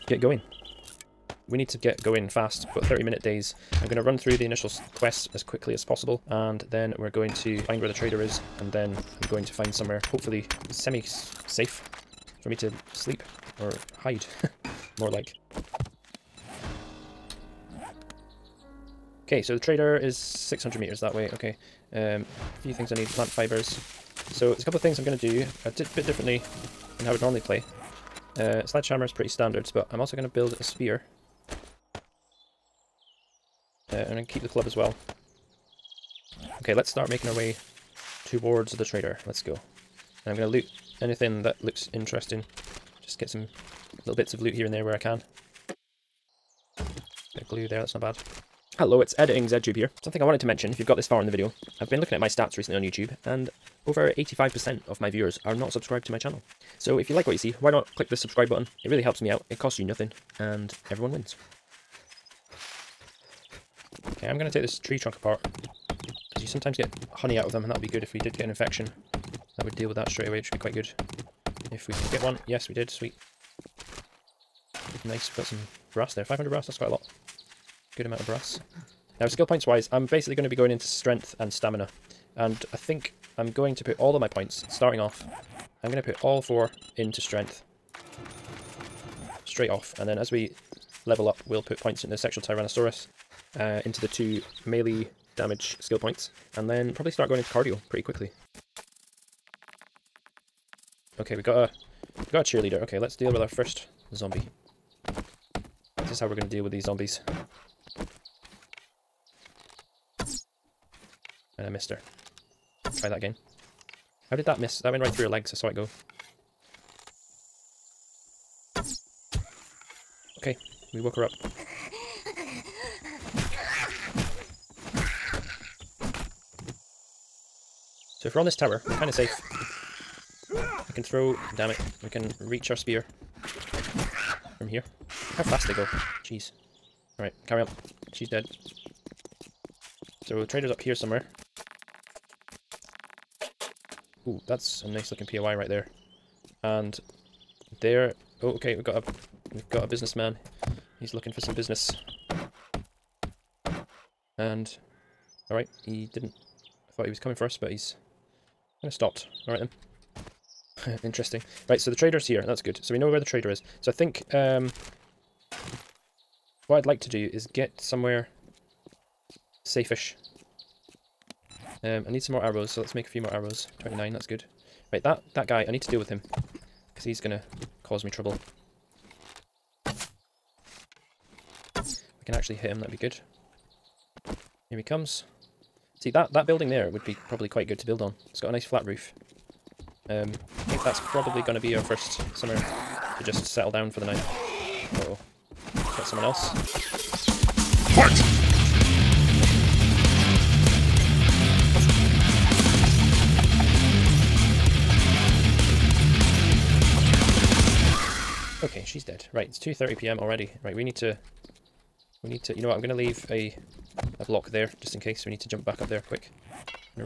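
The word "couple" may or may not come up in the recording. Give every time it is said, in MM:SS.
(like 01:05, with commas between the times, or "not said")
00:24.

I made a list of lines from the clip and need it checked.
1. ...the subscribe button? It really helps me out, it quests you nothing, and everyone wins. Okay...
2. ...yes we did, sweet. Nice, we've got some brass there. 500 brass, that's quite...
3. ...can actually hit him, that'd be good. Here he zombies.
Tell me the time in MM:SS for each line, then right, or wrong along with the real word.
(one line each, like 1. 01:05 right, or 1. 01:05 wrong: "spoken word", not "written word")
1. 00:58 wrong: "costs", not "quests"
2. 01:12 right
3. 03:02 wrong: "comes", not "zombies".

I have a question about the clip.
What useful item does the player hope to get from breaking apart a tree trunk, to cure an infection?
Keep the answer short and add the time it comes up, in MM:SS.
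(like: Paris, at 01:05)
Honey, at 01:07.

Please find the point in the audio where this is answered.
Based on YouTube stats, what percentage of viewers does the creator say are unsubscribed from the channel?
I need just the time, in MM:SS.
00:53.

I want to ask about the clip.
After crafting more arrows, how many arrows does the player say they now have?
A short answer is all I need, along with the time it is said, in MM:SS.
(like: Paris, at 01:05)
29, at 02:53.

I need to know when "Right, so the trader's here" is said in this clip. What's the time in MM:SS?
02:41.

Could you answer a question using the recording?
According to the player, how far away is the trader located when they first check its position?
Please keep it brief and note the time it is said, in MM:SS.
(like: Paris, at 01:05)
600 meters, at 00:20.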